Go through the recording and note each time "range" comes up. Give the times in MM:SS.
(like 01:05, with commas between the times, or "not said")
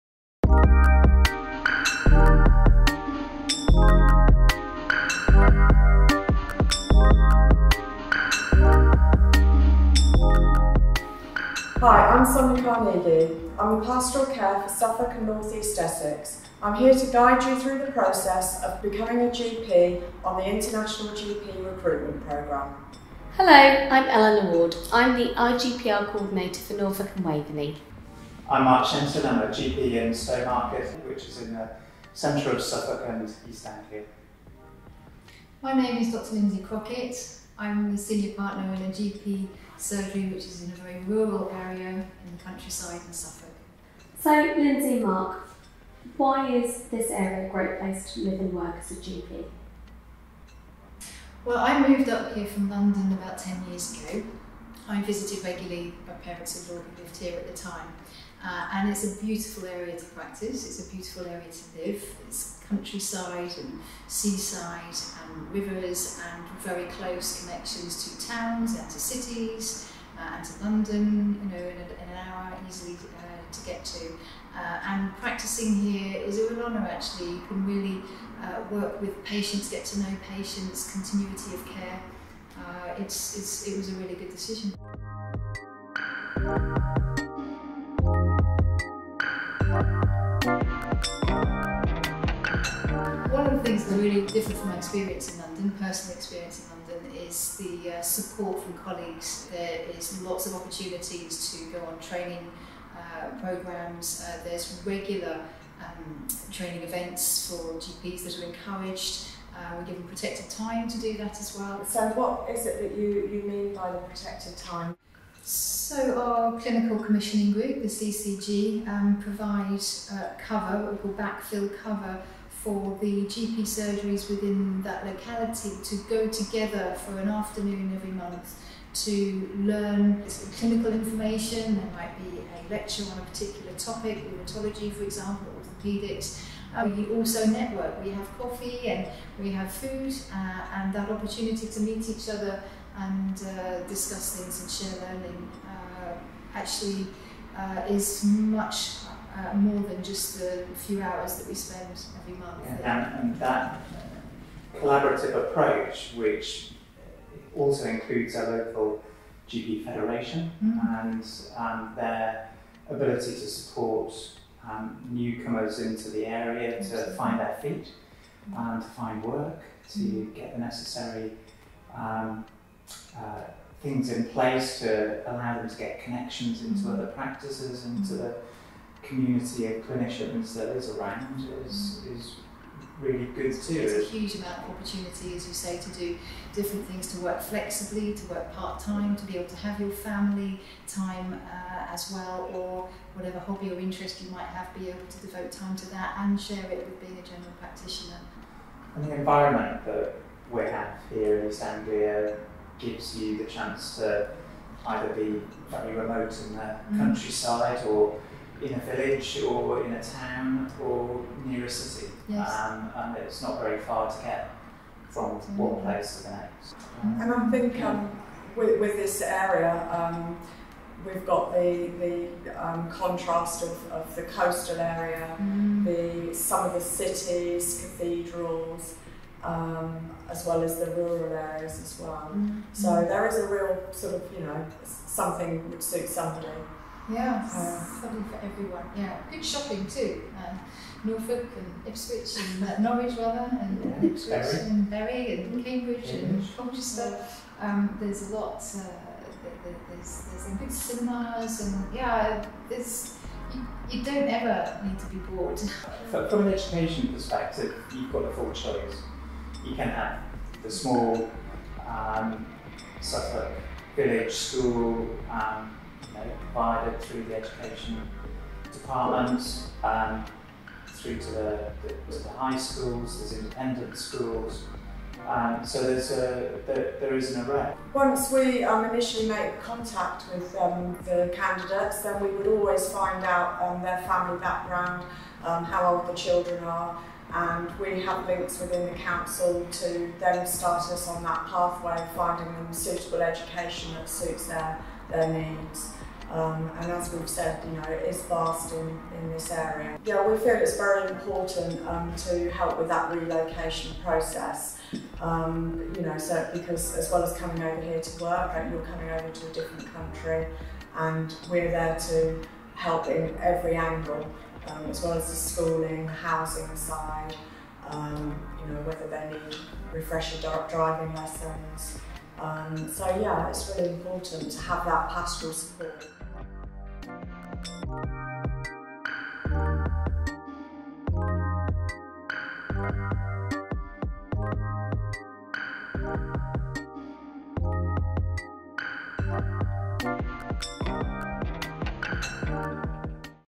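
not said.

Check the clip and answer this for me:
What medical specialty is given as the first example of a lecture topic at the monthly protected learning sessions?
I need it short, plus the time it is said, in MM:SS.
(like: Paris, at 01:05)
rheumatology, at 02:14.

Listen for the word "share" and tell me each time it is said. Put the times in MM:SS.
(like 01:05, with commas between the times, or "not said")
02:24, 03:16.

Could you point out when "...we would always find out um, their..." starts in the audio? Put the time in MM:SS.
04:42.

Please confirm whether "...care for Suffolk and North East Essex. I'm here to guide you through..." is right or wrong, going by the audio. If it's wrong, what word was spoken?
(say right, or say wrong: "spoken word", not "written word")
right.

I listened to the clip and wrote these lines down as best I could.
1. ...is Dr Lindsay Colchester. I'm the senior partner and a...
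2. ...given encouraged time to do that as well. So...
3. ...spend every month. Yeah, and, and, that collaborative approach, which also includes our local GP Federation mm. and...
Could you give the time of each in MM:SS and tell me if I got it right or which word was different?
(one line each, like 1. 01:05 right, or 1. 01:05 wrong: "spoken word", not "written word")
1. 00:35 wrong: "Crockett", not "Colchester"
2. 01:49 wrong: "protected", not "encouraged"
3. 02:31 right.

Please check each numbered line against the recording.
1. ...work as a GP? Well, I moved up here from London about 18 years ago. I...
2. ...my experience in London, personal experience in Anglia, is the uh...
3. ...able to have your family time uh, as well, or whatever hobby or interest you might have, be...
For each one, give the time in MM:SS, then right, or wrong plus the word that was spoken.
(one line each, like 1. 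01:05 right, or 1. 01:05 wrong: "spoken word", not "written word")
1. 00:48 wrong: "10", not "18"
2. 01:34 wrong: "London", not "Anglia"
3. 03:09 right.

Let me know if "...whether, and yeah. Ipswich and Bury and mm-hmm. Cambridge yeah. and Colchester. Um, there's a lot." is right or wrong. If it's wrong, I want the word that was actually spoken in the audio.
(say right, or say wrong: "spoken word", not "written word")
wrong: "rather", not "whether".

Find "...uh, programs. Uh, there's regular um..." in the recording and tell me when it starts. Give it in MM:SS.
01:42.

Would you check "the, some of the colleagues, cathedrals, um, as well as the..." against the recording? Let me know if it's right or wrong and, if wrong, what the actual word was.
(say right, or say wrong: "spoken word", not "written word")
wrong: "cities", not "colleagues".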